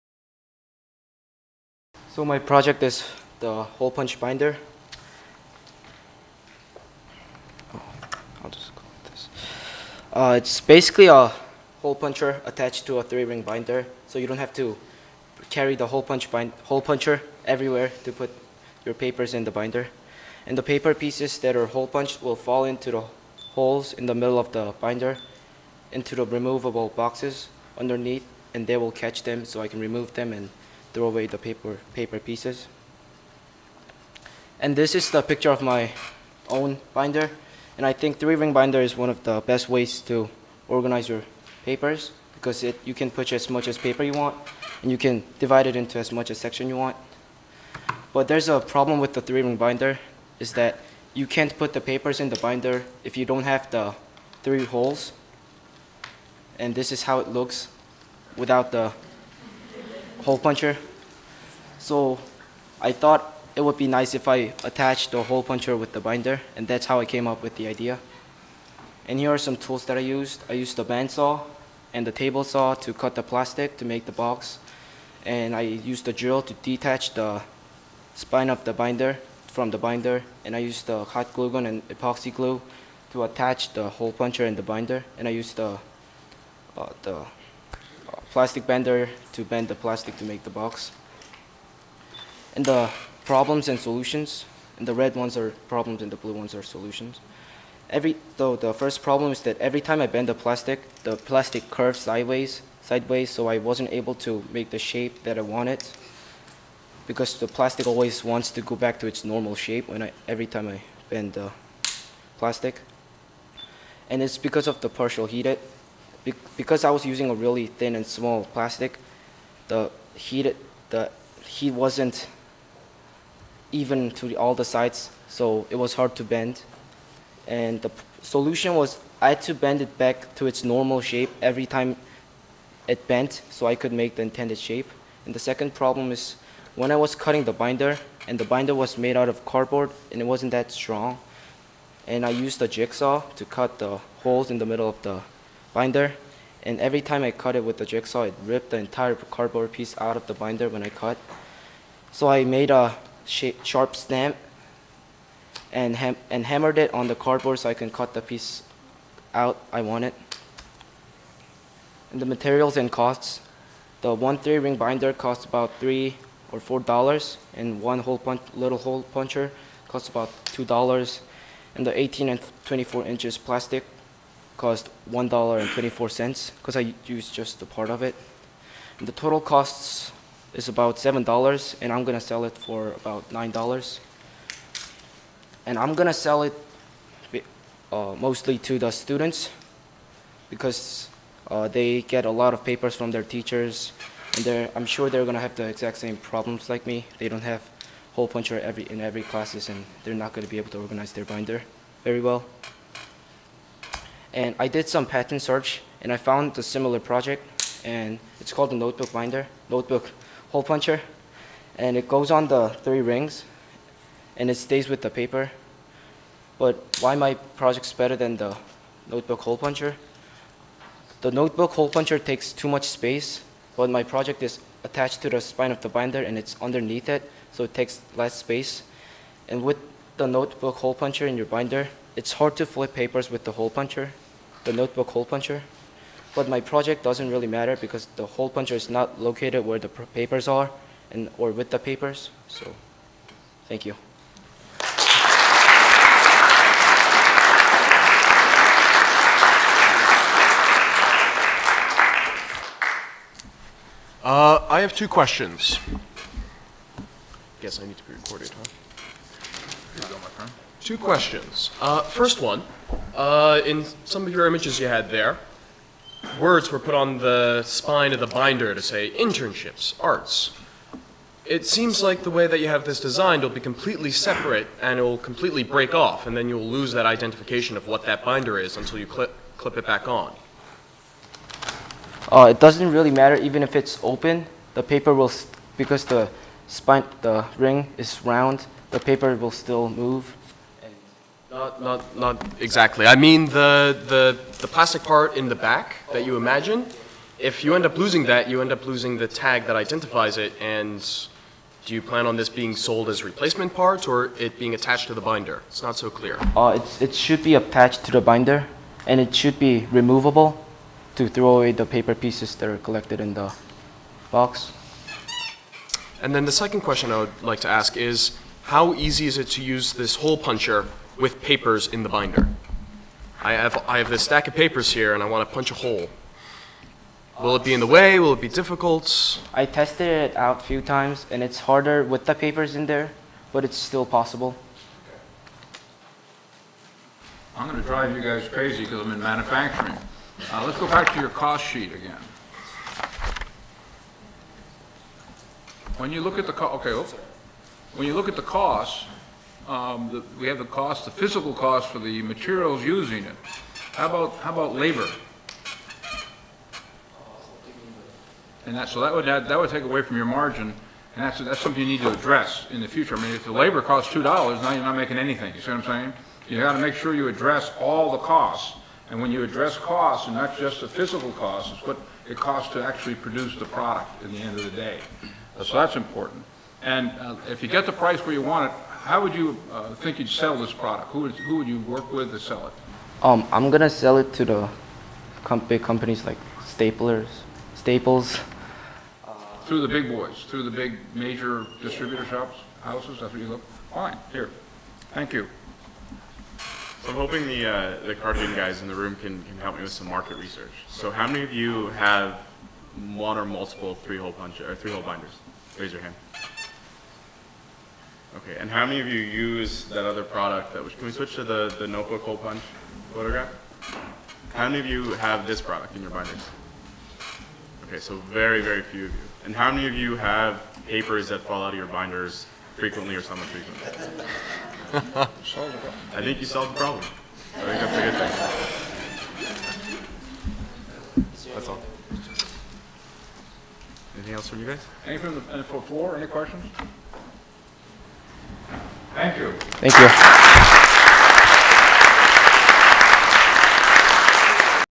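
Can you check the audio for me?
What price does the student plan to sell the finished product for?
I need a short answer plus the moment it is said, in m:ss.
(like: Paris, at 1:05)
$9, at 3:03.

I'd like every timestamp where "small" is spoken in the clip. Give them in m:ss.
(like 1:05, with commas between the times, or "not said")
1:58.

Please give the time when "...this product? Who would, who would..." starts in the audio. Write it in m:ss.
6:20.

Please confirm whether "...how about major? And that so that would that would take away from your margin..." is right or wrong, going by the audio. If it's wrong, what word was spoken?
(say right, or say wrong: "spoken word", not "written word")
wrong: "labor", not "major".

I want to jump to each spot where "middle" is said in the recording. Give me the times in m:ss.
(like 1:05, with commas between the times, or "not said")
0:24, 2:24.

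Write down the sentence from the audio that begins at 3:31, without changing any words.
And it goes on the three rings and it stays with the paper.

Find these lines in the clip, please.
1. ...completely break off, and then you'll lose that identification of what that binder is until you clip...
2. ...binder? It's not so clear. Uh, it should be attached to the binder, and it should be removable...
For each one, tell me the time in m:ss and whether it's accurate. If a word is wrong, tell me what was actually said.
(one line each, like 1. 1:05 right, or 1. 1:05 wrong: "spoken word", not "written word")
1. 4:35 right
2. 5:05 right.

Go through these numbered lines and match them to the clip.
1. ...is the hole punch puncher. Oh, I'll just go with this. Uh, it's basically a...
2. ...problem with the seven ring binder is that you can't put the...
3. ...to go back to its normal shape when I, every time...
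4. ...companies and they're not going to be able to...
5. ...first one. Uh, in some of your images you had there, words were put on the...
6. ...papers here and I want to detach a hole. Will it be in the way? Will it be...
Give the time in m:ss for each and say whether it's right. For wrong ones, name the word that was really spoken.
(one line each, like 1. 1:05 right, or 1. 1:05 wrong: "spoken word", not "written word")
1. 0:02 wrong: "binder", not "puncher"
2. 0:48 wrong: "three", not "seven"
3. 1:48 right
4. 3:19 wrong: "classes", not "companies"
5. 4:22 right
6. 5:24 wrong: "punch", not "detach".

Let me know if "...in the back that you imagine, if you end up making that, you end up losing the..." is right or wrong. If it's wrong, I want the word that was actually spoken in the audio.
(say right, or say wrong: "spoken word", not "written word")
wrong: "losing", not "making".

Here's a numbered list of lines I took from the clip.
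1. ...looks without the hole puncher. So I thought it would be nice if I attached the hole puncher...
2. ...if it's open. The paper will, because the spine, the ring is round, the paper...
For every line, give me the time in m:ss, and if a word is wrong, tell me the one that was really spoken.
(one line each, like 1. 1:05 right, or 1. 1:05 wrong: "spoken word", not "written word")
1. 0:57 right
2. 4:43 right.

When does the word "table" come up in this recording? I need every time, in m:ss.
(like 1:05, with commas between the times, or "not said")
1:12.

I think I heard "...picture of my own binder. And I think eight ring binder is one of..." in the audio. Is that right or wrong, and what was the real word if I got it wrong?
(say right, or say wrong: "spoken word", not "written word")
wrong: "three", not "eight".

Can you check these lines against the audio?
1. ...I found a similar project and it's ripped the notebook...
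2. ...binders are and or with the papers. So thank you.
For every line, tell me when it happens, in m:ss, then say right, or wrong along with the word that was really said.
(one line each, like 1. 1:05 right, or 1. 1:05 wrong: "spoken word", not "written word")
1. 3:26 wrong: "called", not "ripped"
2. 3:59 wrong: "papers", not "binders".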